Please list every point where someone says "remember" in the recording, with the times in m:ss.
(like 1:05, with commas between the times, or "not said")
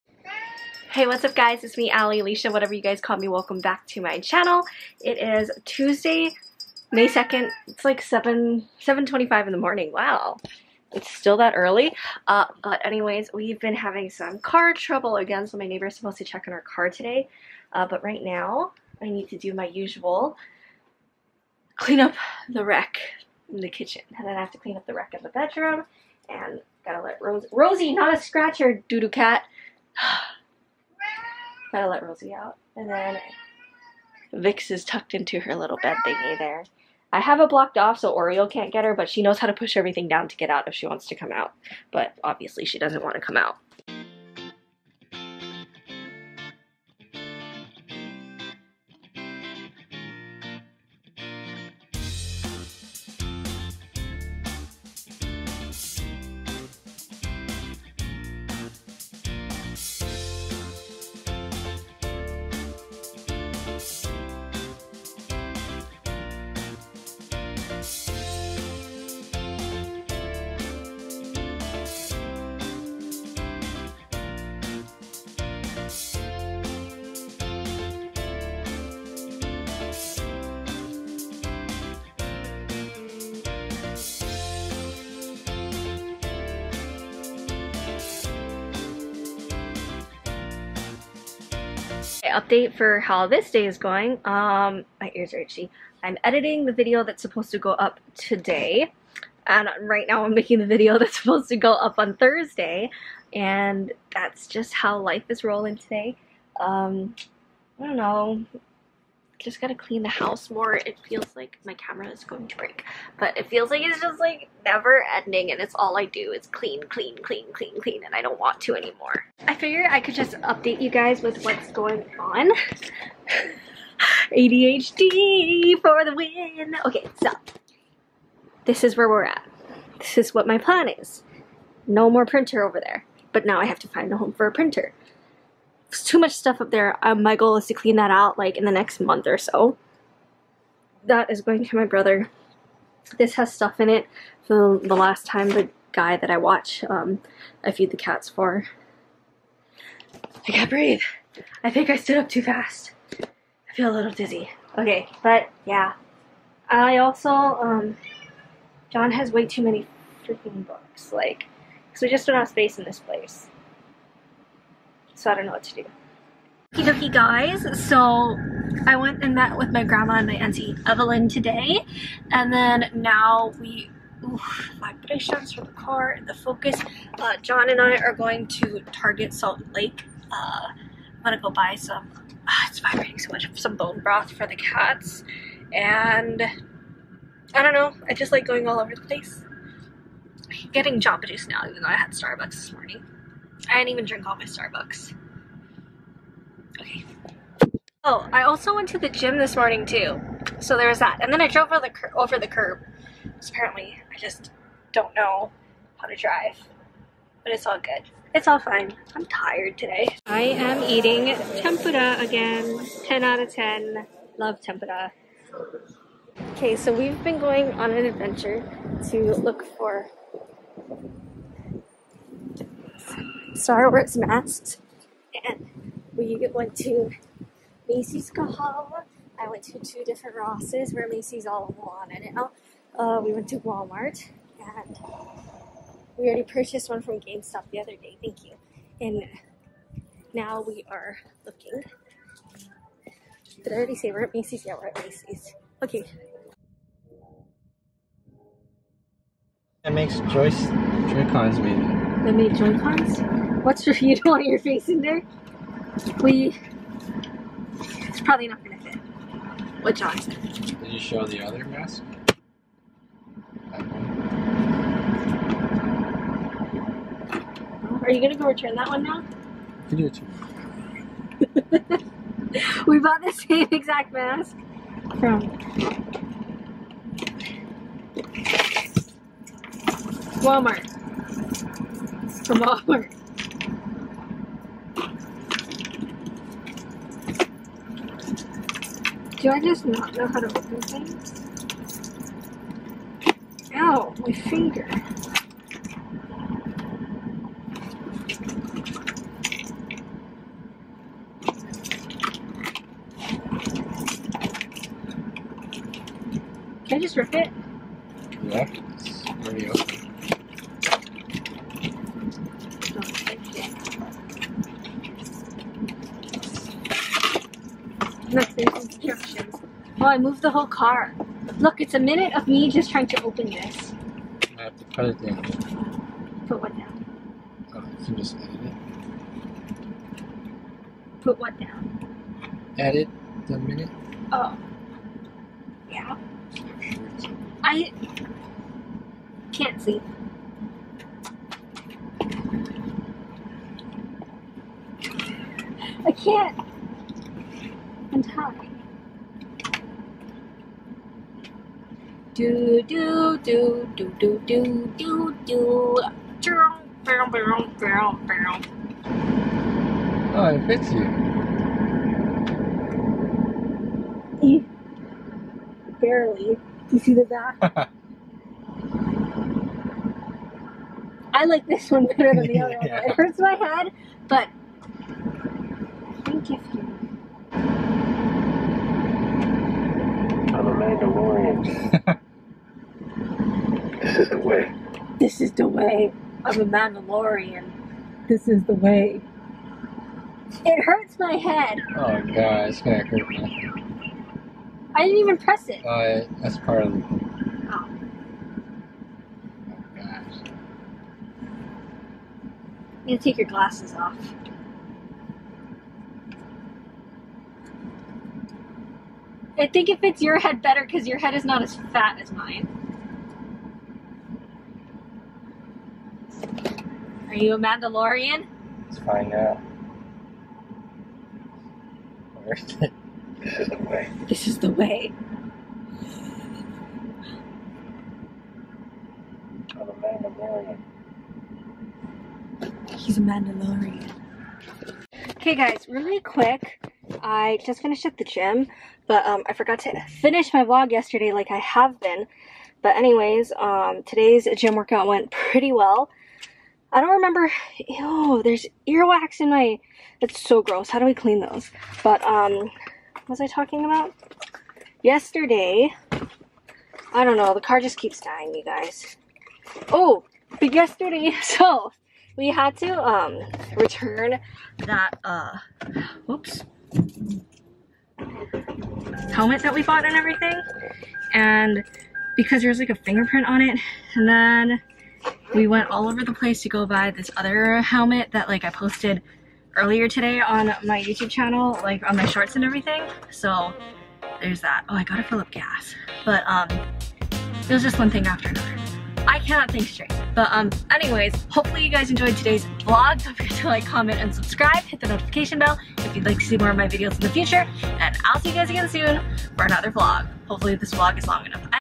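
7:27.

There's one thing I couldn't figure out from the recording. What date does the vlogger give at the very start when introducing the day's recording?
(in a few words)
Tuesday, May 2nd.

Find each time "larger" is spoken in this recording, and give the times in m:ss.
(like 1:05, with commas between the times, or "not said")
not said.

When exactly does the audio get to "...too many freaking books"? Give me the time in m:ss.
2:39.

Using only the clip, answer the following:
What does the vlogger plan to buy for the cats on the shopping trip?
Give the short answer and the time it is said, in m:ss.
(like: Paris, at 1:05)
Bone broth, at 3:03.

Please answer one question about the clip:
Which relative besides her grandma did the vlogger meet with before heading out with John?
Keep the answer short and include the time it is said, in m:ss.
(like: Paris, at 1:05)
Auntie Evelyn, at 2:50.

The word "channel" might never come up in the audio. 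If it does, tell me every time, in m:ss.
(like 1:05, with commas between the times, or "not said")
0:04, 8:01.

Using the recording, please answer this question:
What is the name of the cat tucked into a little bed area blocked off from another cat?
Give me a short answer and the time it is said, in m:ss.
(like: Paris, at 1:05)
Vix, at 0:34.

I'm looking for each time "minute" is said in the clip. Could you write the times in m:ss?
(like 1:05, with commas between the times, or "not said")
5:21, 5:33.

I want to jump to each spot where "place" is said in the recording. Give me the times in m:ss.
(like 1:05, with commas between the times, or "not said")
2:42, 3:09, 7:56.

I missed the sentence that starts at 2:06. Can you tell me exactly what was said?
Okay, so this is where we're at.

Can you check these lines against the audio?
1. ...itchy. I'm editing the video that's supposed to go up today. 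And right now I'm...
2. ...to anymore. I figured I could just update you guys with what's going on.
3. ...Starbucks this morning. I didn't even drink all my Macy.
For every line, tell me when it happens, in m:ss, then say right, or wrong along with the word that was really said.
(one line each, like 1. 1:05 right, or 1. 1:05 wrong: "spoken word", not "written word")
1. 1:35 right
2. 1:58 right
3. 3:12 wrong: "Starbucks", not "Macy".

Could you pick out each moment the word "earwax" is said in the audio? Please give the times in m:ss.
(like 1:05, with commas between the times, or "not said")
7:28.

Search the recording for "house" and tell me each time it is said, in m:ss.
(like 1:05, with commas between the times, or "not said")
1:50.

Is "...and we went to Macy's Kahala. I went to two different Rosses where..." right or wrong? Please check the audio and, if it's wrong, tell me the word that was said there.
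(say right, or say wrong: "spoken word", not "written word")
right.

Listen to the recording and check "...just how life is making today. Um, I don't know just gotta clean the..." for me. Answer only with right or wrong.
wrong.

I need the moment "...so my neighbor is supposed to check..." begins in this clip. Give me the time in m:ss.
0:15.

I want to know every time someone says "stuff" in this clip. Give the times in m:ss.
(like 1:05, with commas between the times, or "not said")
2:16, 2:23.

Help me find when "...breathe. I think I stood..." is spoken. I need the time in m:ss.
2:30.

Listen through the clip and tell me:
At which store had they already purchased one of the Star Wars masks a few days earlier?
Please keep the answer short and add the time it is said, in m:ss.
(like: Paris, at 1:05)
GameStop, at 3:57.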